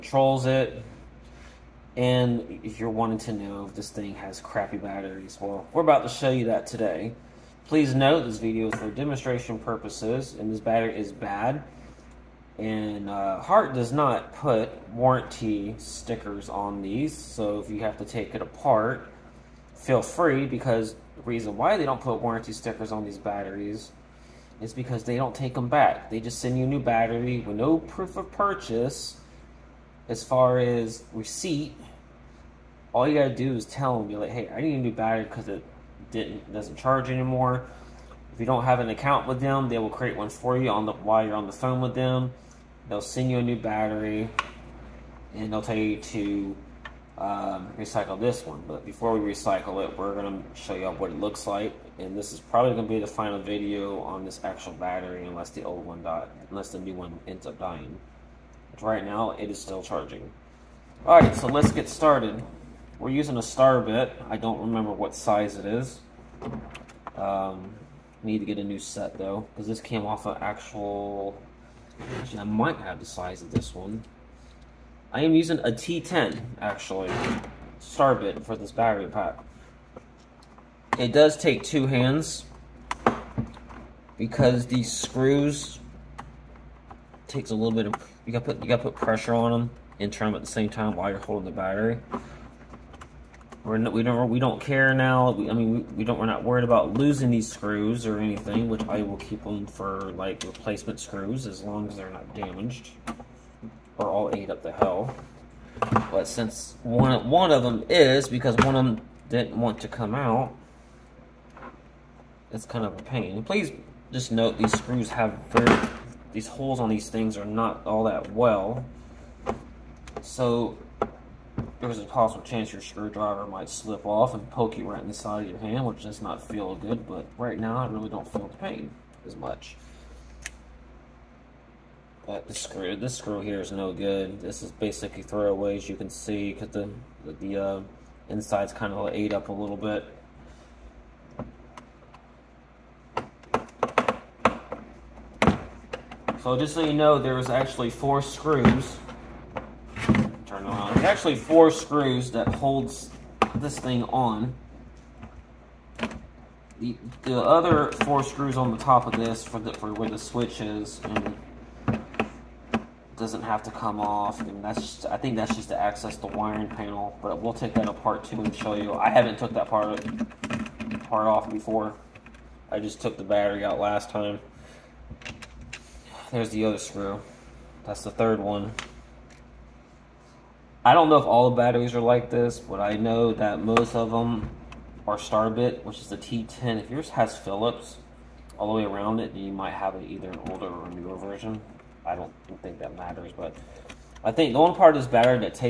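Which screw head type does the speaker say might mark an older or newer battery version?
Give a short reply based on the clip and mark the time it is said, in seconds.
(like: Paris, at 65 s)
Phillips, at 187 s.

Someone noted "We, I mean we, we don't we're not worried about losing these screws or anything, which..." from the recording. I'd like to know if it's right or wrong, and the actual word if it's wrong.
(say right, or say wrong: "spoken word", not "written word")
right.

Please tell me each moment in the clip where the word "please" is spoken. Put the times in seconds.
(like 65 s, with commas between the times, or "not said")
7 s, 113 s.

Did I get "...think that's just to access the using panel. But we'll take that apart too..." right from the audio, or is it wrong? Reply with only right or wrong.
wrong.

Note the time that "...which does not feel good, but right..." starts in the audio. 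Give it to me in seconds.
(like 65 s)
125 s.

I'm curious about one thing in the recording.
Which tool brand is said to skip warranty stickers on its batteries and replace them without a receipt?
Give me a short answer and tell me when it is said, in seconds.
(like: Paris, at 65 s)
Hart, at 13 s.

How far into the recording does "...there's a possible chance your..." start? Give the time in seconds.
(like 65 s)
121 s.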